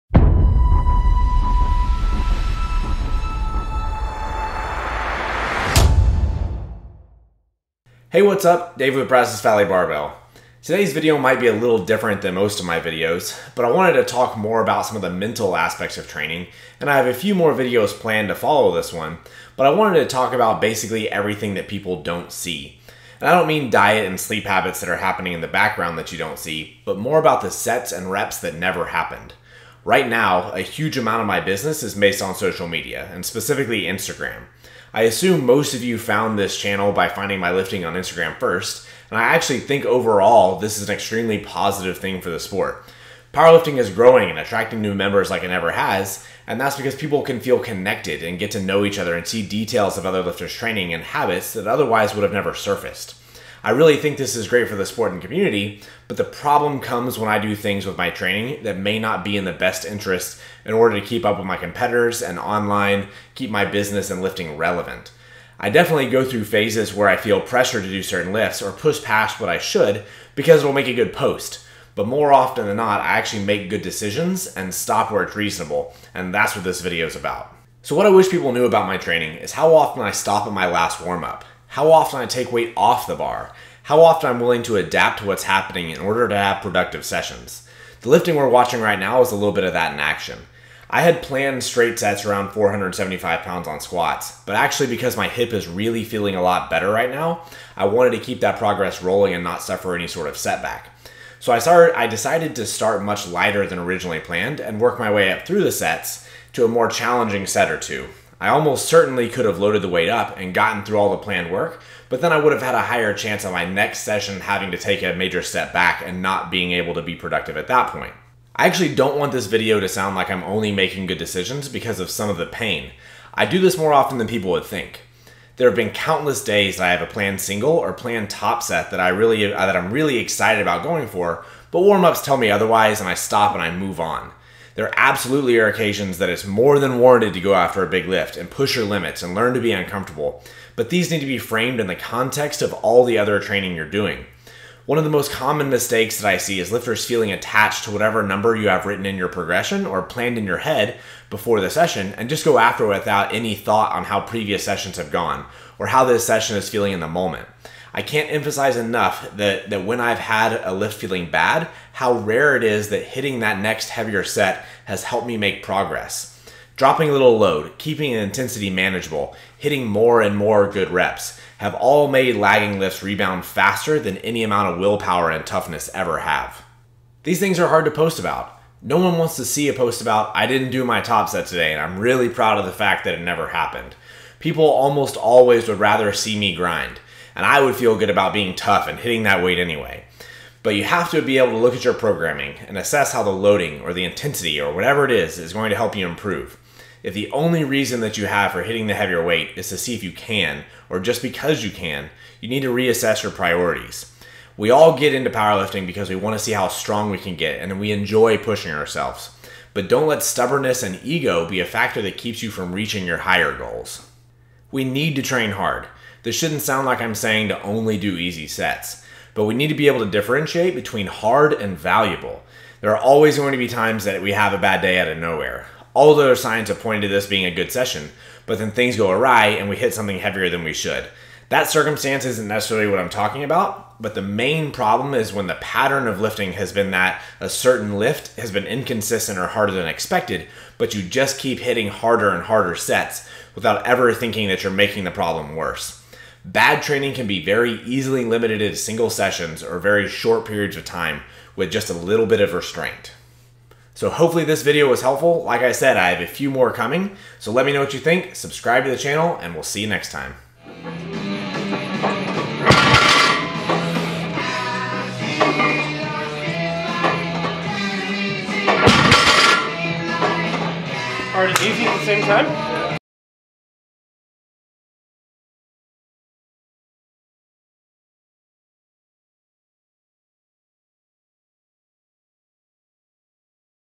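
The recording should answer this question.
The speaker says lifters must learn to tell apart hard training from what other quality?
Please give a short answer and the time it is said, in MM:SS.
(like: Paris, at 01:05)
valuable, at 03:41.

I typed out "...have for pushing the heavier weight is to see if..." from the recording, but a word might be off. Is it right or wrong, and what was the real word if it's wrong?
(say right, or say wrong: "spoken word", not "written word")
wrong: "hitting", not "pushing".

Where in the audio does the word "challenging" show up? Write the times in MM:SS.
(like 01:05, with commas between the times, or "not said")
01:46.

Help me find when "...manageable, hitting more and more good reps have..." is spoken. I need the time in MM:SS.
02:48.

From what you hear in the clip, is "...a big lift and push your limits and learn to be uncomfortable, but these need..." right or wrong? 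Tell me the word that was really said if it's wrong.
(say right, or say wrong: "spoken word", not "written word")
right.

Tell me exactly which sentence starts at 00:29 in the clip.
Right now, a huge amount of my business is based on social media, and specifically Instagram.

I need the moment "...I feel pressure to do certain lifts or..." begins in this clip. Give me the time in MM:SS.
01:07.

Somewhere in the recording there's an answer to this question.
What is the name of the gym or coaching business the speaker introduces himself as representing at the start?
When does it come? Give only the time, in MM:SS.
00:09.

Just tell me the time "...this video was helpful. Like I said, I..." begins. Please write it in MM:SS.
04:14.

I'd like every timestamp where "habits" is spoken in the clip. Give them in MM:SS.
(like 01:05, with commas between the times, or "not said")
00:24, 00:51.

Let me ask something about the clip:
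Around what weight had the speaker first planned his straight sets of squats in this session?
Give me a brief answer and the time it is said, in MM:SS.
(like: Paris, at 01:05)
475 pounds, at 01:32.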